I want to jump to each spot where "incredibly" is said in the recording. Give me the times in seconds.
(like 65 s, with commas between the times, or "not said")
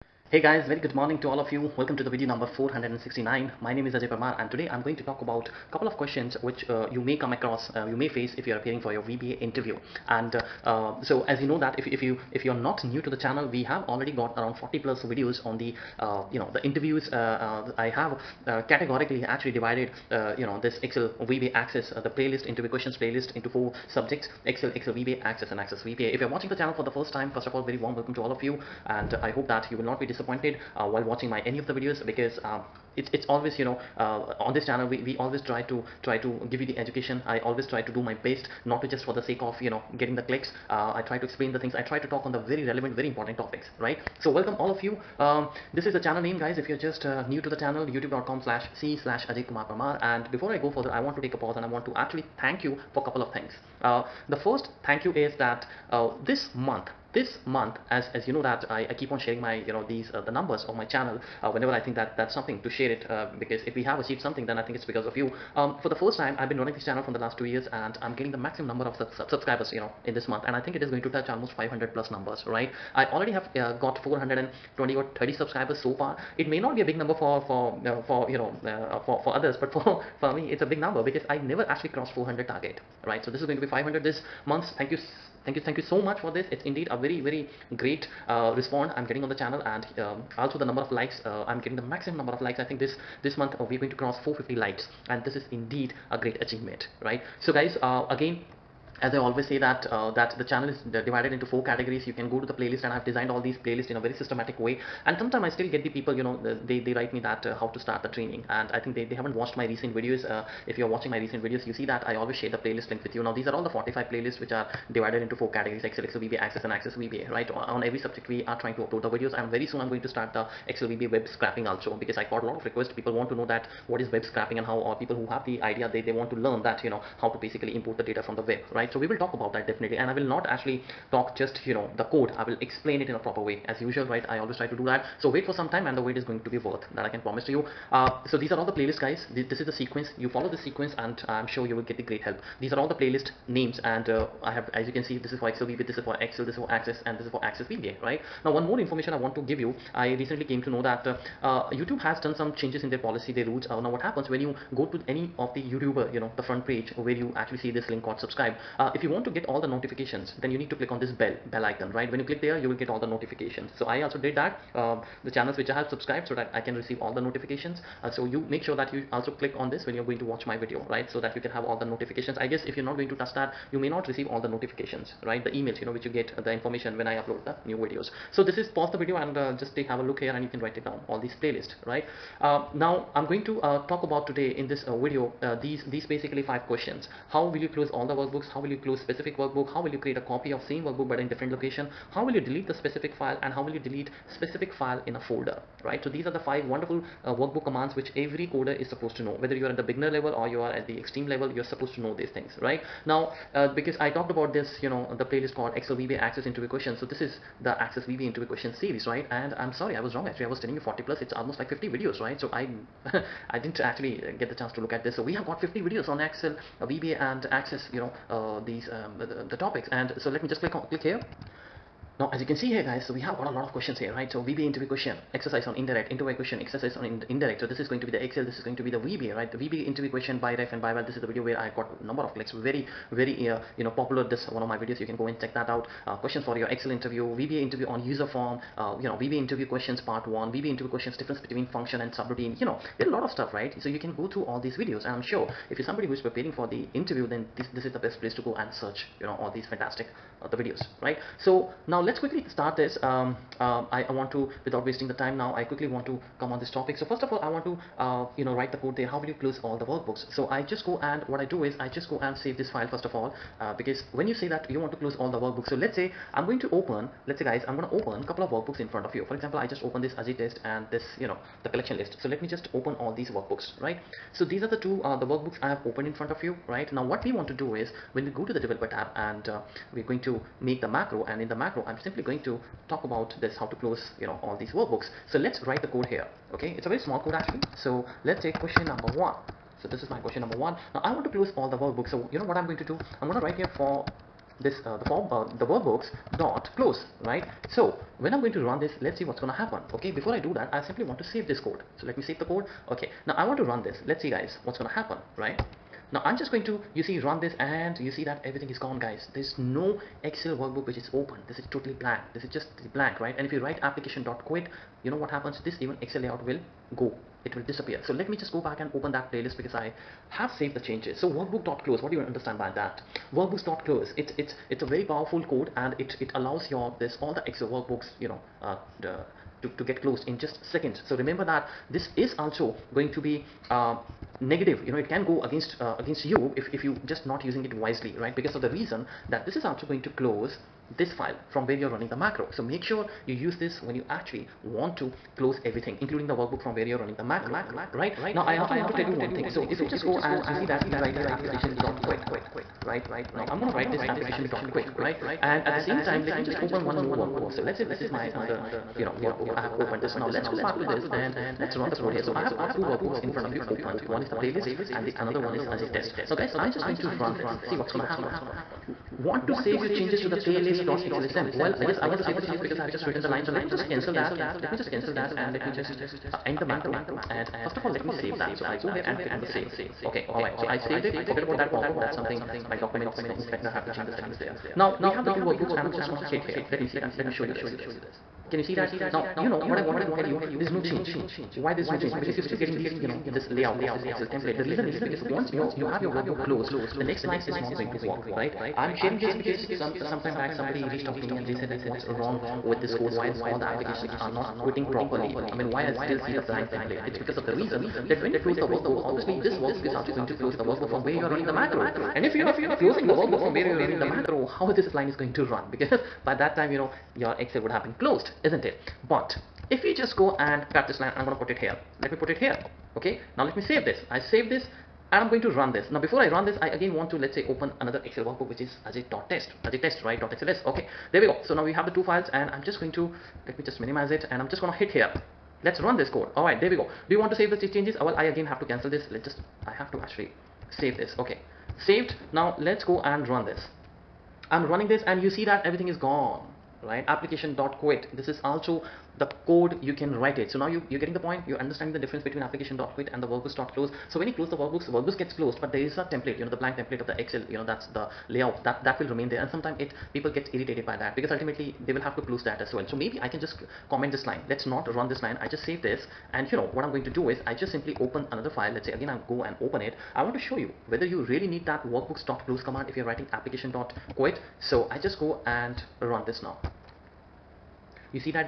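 not said.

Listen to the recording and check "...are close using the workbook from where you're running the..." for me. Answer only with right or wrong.
right.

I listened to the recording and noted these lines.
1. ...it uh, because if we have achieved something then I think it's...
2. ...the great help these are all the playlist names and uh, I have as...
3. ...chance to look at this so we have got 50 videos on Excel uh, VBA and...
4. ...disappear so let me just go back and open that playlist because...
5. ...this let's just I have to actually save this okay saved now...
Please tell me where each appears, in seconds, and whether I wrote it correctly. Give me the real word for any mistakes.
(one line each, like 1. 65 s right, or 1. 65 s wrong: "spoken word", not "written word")
1. 62 s right
2. 141 s right
3. 214 s right
4. 317 s right
5. 438 s right.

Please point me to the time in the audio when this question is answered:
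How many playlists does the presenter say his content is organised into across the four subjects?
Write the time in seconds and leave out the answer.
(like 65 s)
113 s.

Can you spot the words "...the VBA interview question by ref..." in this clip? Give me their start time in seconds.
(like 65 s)
229 s.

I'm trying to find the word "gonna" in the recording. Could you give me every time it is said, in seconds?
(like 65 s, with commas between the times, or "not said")
267 s, 299 s, 304 s, 353 s, 367 s, 386 s, 434 s.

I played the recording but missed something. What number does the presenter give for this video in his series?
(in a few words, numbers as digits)
469.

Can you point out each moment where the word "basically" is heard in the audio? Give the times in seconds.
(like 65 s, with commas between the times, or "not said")
127 s, 186 s.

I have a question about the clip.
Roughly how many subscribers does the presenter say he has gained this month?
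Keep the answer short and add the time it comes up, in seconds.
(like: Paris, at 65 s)
420 or 30, at 74 s.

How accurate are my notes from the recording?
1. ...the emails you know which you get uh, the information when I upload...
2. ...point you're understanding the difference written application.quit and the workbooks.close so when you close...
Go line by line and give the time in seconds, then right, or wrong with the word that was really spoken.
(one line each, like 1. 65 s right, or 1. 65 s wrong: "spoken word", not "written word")
1. 175 s right
2. 451 s wrong: "between", not "written".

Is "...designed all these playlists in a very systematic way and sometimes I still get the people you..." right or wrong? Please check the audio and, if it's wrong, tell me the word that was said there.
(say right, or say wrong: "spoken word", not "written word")
right.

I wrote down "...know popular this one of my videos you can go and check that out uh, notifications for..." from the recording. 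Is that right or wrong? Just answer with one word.
wrong.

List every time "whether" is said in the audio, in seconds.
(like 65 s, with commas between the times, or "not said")
199 s, 470 s.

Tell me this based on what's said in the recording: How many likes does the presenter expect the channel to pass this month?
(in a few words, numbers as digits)
450.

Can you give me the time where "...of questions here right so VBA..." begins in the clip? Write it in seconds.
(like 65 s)
223 s.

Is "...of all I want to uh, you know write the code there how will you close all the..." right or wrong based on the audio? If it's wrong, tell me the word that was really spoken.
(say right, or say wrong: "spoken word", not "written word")
right.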